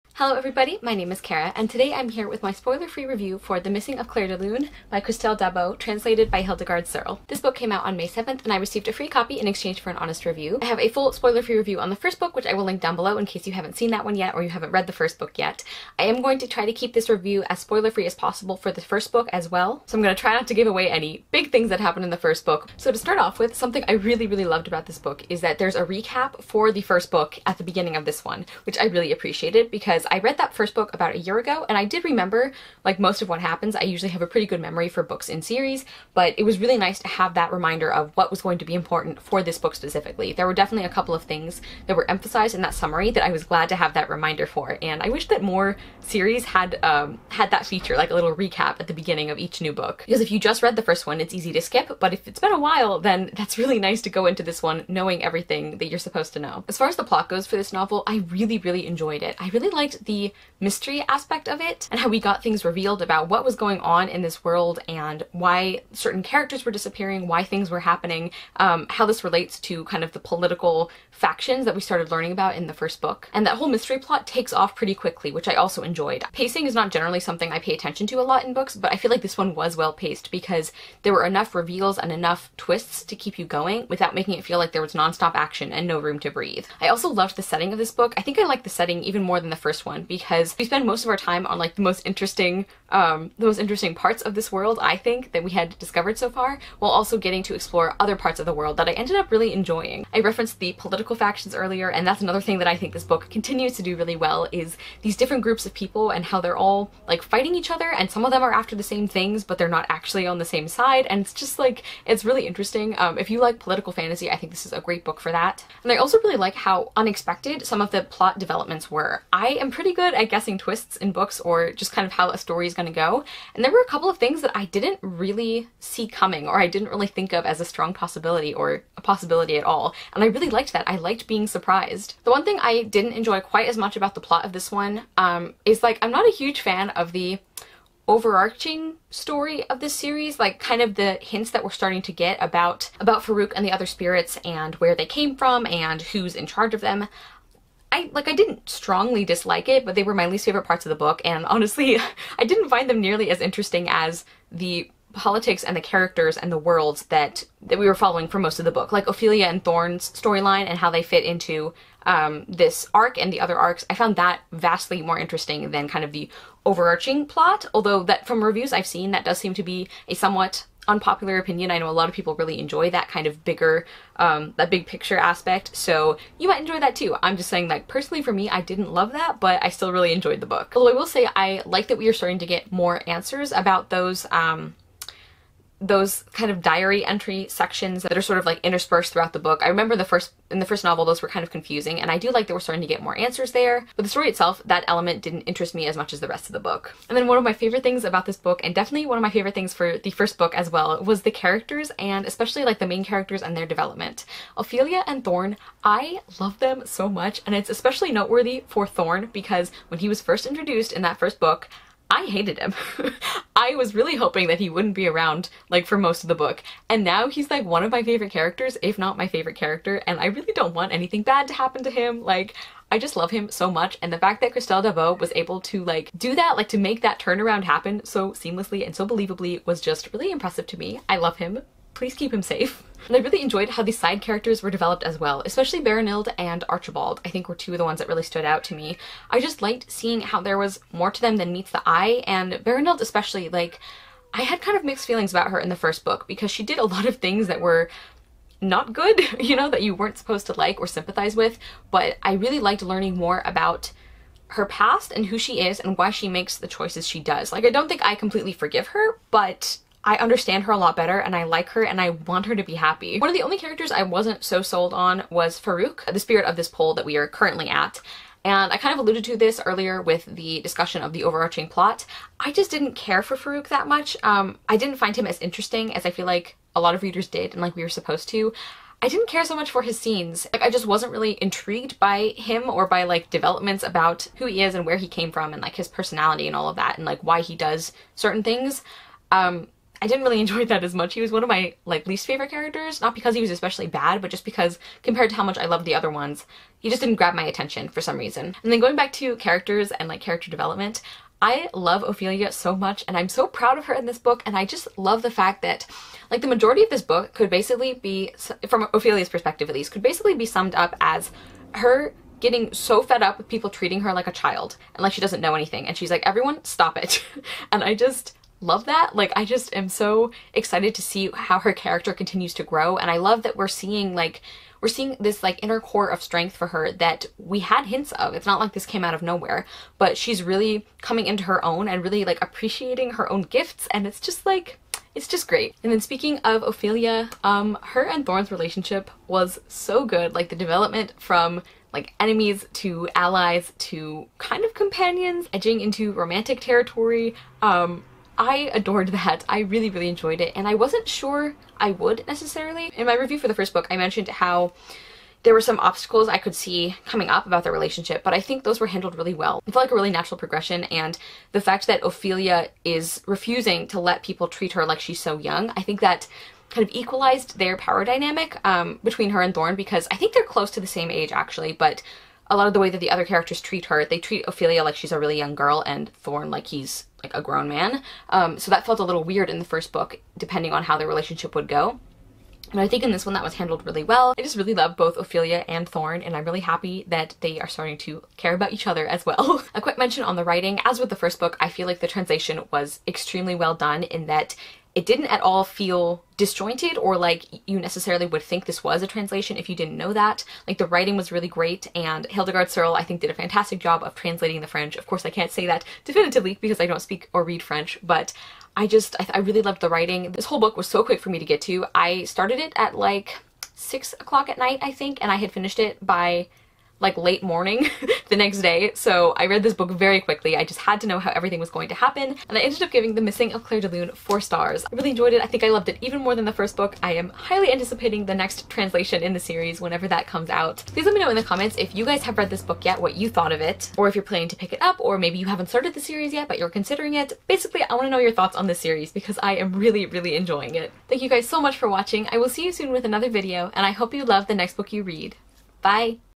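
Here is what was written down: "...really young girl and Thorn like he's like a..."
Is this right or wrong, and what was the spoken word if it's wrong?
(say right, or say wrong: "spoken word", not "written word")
right.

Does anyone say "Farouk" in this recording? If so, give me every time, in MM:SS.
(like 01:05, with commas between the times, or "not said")
02:23, 04:25, 04:33.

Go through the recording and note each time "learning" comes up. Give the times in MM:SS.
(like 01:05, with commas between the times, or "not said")
01:12, 04:12.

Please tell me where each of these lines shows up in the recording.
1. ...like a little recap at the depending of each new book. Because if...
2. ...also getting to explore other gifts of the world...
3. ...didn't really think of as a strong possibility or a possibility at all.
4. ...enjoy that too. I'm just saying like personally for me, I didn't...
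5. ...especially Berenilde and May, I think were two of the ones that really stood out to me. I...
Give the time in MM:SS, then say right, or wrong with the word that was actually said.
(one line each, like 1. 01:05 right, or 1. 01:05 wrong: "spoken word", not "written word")
1. 00:47 wrong: "beginning", not "depending"
2. 01:36 wrong: "parts", not "gifts"
3. 02:06 right
4. 02:56 right
5. 03:55 wrong: "Archibald", not "May".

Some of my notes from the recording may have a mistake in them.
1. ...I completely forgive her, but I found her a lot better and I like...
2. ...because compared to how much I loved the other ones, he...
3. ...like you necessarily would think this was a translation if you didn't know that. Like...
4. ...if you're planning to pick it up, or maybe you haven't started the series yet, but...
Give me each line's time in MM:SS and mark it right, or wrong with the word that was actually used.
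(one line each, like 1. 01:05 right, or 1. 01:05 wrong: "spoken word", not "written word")
1. 04:18 wrong: "understand", not "found"
2. 04:54 right
3. 06:37 right
4. 07:14 right.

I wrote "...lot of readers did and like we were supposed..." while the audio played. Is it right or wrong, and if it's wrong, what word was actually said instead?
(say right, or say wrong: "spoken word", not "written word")
right.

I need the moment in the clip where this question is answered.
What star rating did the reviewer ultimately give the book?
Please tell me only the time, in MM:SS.
07:04.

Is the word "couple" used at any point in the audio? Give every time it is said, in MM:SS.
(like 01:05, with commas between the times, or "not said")
00:40, 02:03.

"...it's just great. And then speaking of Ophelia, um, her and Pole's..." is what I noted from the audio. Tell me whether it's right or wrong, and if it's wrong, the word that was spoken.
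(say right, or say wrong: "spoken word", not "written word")
wrong: "Thorn", not "Pole".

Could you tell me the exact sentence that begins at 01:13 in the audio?
And that whole mystery plot takes off pretty quickly, which I also enjoyed.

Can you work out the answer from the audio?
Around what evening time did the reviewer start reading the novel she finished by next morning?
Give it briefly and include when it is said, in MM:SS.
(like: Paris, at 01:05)
6 o'clock, at 06:53.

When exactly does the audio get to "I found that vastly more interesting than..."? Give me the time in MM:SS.
02:43.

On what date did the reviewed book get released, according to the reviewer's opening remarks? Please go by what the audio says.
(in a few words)
May 7.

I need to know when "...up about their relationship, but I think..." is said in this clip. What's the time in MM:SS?
05:57.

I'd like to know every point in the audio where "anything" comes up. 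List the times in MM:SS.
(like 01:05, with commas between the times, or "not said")
03:40, 05:15.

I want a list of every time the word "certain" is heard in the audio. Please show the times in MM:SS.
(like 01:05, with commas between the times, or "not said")
01:05, 04:48.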